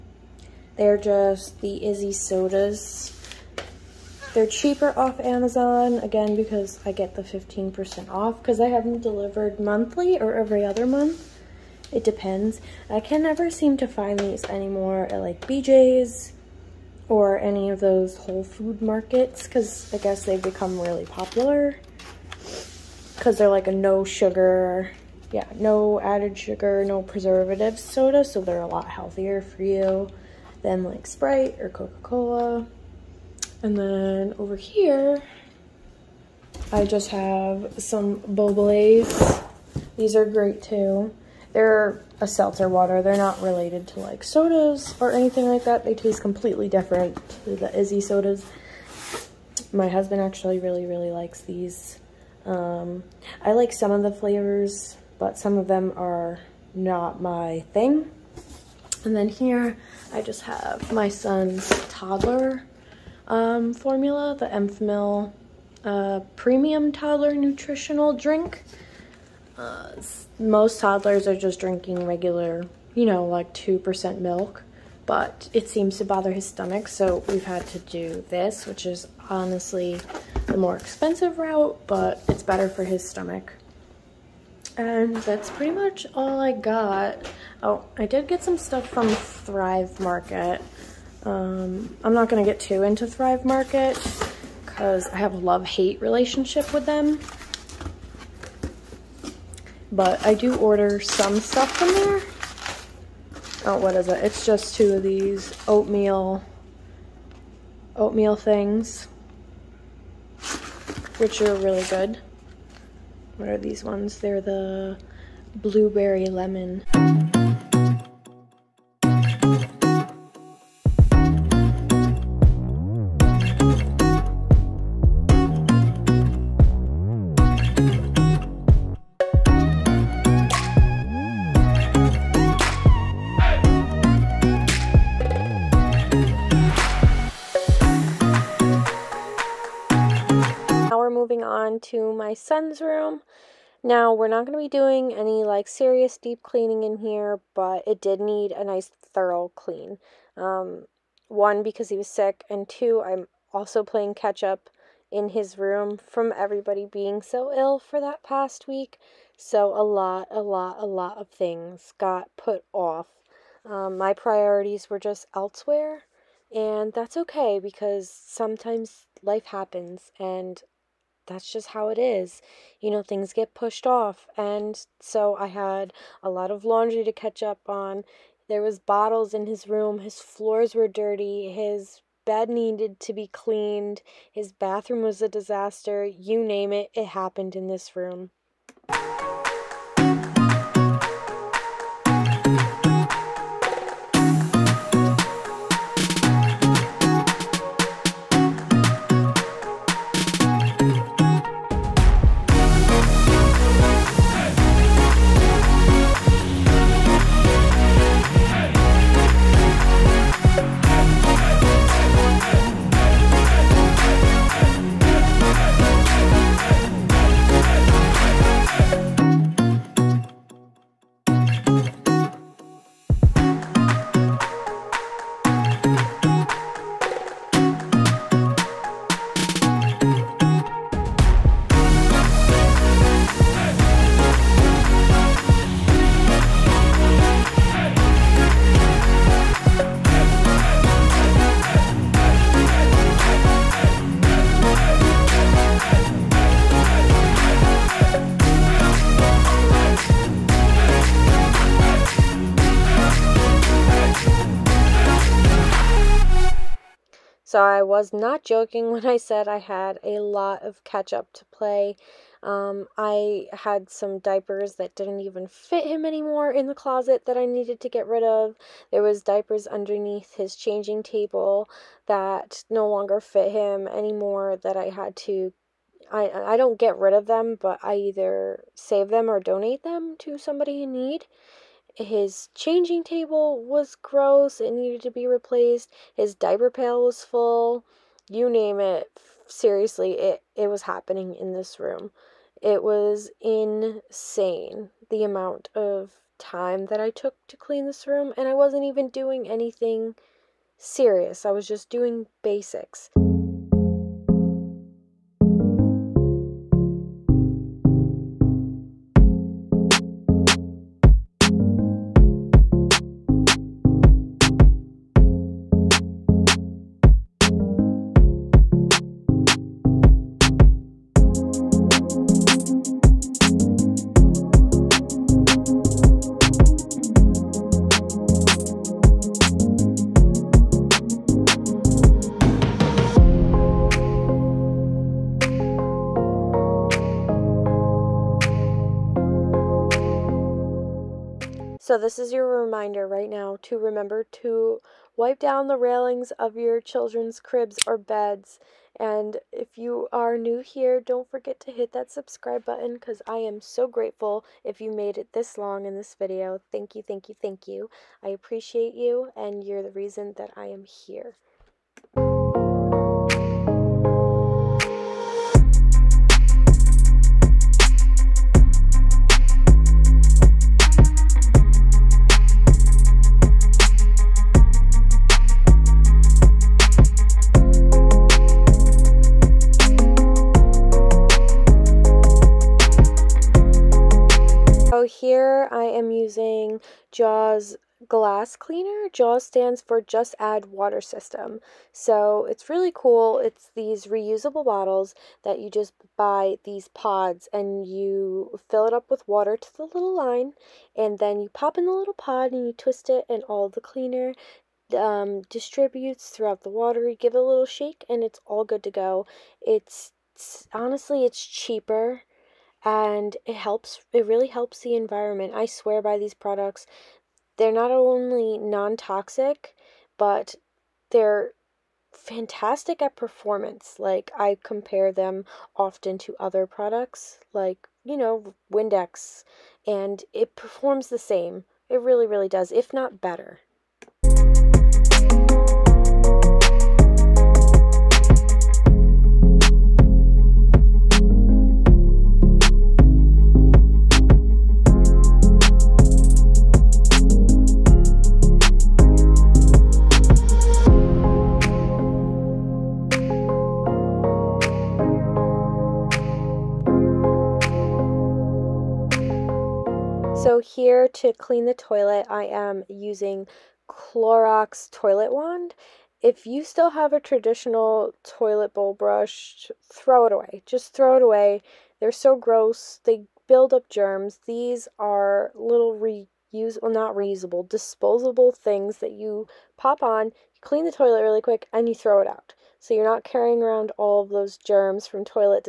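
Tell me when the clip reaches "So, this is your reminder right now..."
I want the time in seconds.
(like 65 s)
341 s.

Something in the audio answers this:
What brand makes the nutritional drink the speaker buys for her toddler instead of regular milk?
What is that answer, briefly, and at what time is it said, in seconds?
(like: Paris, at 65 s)
Enfamil, at 64 s.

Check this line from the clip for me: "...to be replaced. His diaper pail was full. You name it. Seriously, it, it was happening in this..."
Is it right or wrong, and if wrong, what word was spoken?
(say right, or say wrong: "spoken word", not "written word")
right.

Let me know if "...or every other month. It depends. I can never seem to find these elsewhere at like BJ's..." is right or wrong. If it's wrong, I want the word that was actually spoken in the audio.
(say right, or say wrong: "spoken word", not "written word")
wrong: "anymore", not "elsewhere".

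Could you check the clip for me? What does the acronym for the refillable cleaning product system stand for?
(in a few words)
Just Add Water System.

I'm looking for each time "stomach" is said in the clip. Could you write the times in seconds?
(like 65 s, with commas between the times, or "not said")
76 s, 83 s.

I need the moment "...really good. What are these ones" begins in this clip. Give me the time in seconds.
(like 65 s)
111 s.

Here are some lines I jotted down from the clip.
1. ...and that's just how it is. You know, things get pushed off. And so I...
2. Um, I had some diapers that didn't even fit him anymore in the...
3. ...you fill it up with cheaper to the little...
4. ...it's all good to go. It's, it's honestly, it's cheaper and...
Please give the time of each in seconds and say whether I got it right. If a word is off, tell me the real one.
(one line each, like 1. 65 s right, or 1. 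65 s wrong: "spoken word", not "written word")
1. 170 s right
2. 262 s right
3. 397 s wrong: "water", not "cheaper"
4. 408 s right.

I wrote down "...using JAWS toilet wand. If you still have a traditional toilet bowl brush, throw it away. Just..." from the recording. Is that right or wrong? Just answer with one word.
wrong.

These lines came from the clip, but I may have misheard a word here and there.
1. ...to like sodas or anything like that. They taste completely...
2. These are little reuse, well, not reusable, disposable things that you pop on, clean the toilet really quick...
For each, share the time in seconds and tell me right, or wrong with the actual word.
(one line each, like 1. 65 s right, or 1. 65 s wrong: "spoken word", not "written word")
1. 43 s right
2. 474 s right.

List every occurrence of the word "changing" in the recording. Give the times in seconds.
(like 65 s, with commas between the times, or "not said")
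270 s, 282 s.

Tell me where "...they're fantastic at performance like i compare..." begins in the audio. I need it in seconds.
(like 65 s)
421 s.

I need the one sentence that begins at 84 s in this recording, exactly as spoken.
And that's pretty much all I got.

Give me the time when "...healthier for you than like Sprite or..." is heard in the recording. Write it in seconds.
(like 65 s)
28 s.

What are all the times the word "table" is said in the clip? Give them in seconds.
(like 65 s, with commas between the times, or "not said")
271 s, 283 s.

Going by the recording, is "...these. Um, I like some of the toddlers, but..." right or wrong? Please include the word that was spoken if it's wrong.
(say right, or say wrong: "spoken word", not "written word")
wrong: "flavors", not "toddlers".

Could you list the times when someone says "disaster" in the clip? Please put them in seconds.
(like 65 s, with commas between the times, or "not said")
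185 s.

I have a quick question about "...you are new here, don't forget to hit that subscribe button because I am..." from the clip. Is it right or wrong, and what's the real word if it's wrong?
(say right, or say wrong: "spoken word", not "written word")
right.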